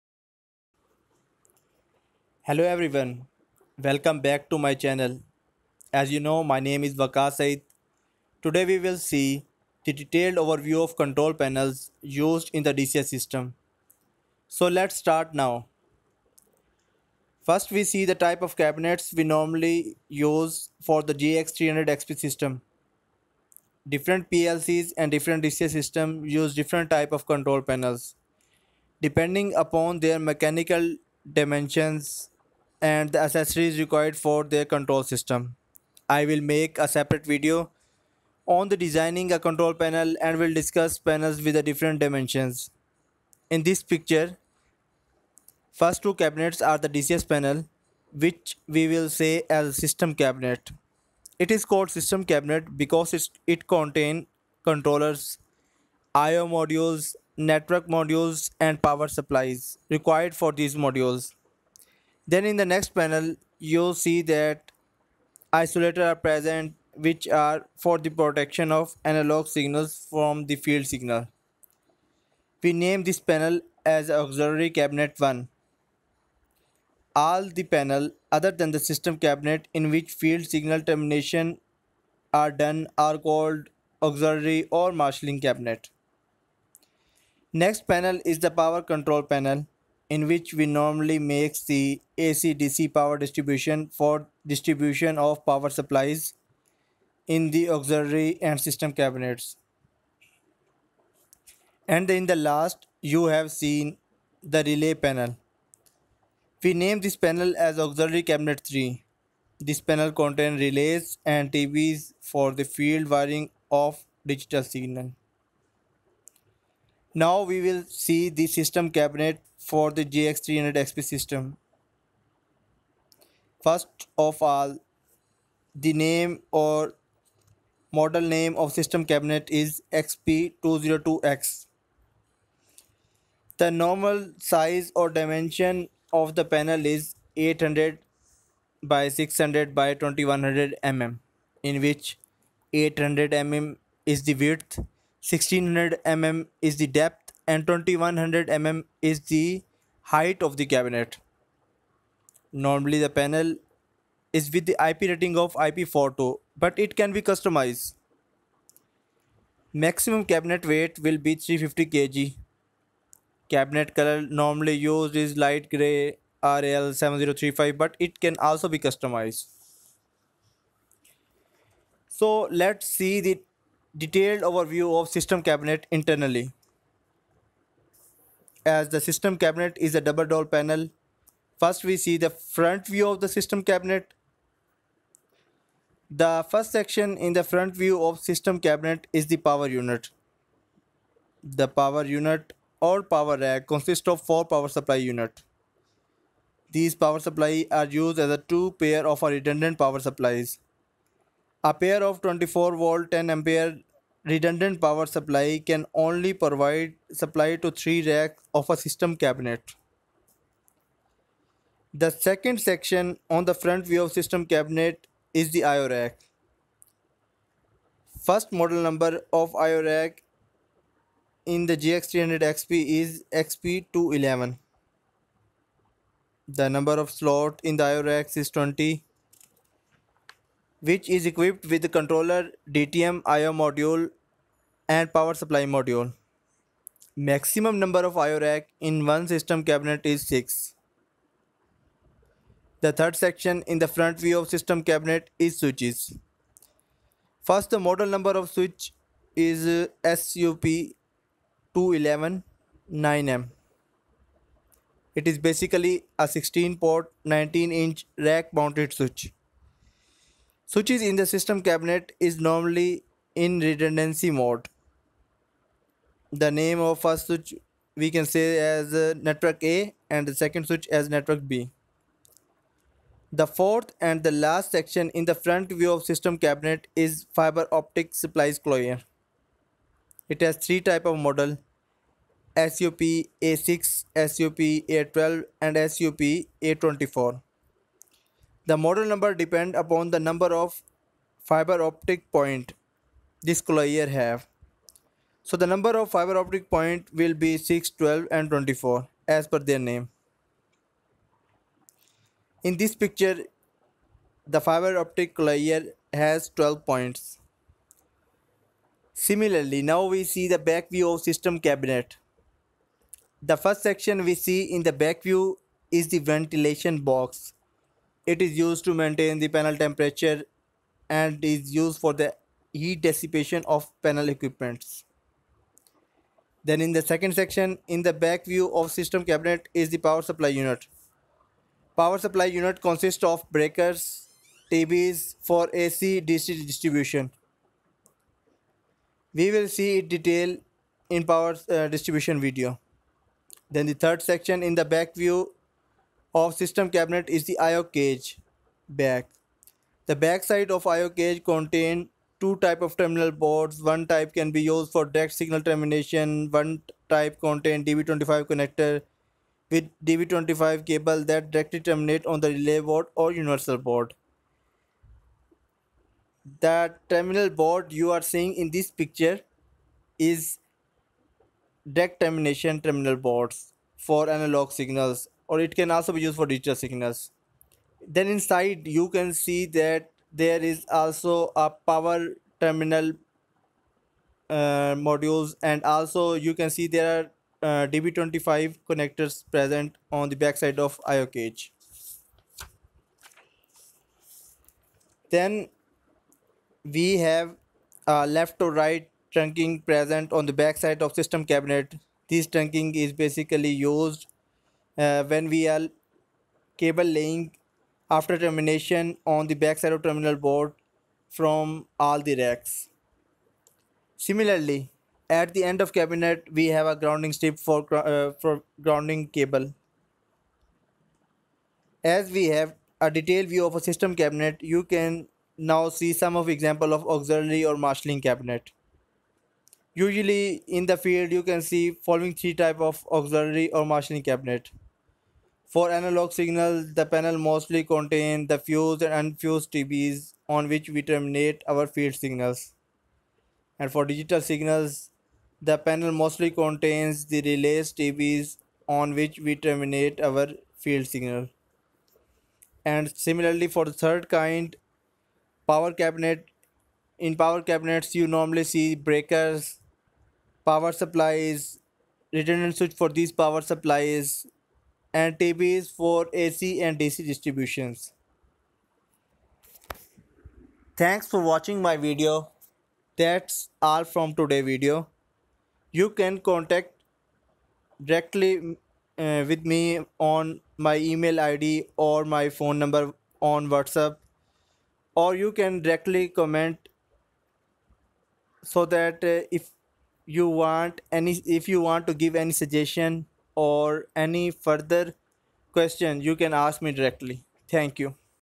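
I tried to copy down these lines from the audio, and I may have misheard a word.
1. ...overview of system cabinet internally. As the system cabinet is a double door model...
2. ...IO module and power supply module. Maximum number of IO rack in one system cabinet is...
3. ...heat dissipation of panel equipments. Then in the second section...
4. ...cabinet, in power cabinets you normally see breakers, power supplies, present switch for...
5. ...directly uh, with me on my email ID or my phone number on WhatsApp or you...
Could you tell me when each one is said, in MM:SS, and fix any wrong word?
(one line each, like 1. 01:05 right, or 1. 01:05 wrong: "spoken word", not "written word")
1. 02:54 wrong: "panel", not "model"
2. 03:53 right
3. 05:22 right
4. 07:35 wrong: "redundant", not "present"
5. 07:58 right.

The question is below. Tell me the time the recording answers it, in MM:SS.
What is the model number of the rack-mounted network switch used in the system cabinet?
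04:10.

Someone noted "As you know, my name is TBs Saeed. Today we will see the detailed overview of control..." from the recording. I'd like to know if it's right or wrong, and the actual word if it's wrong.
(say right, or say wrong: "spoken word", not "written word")
wrong: "Waqas", not "TBs".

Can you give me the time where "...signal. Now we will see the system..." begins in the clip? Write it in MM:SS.
01:54.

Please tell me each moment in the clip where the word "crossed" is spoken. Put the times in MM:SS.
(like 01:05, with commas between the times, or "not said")
not said.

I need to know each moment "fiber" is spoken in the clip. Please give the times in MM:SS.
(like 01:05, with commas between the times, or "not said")
04:37, 04:51, 04:56, 05:04.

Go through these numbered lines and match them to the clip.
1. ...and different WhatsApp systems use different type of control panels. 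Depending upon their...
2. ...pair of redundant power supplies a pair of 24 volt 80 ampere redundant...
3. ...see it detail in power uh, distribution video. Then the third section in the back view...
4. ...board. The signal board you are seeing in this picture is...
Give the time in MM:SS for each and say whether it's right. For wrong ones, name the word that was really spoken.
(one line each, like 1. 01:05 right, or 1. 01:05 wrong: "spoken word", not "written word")
1. 00:24 wrong: "DCS", not "WhatsApp"
2. 03:18 wrong: "10", not "80"
3. 05:39 right
4. 06:03 wrong: "terminal", not "signal".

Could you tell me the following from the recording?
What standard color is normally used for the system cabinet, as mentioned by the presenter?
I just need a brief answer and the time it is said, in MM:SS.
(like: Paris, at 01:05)
Light gray RAL7035, at 02:45.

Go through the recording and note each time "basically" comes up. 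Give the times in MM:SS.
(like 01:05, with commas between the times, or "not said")
04:15, 06:43.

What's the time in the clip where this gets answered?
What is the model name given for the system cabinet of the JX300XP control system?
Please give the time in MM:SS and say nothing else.
02:09.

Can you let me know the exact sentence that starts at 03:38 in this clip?
First model number of IO rack in the JX300XP is XP211.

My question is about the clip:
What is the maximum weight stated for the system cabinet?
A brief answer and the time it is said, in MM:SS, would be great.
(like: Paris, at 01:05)
350 kg, at 02:41.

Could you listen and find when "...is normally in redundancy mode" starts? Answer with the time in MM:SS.
04:22.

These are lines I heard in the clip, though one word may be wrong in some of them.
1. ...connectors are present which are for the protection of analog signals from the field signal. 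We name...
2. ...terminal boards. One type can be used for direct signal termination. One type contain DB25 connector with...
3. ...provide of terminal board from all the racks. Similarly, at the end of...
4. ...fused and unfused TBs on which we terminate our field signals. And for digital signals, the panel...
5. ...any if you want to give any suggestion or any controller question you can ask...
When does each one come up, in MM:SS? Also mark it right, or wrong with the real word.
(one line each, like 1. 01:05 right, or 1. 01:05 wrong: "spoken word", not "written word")
1. 01:05 wrong: "isolators", not "connectors"
2. 05:52 right
3. 06:49 wrong: "backside", not "provide"
4. 07:18 right
5. 08:11 wrong: "further", not "controller".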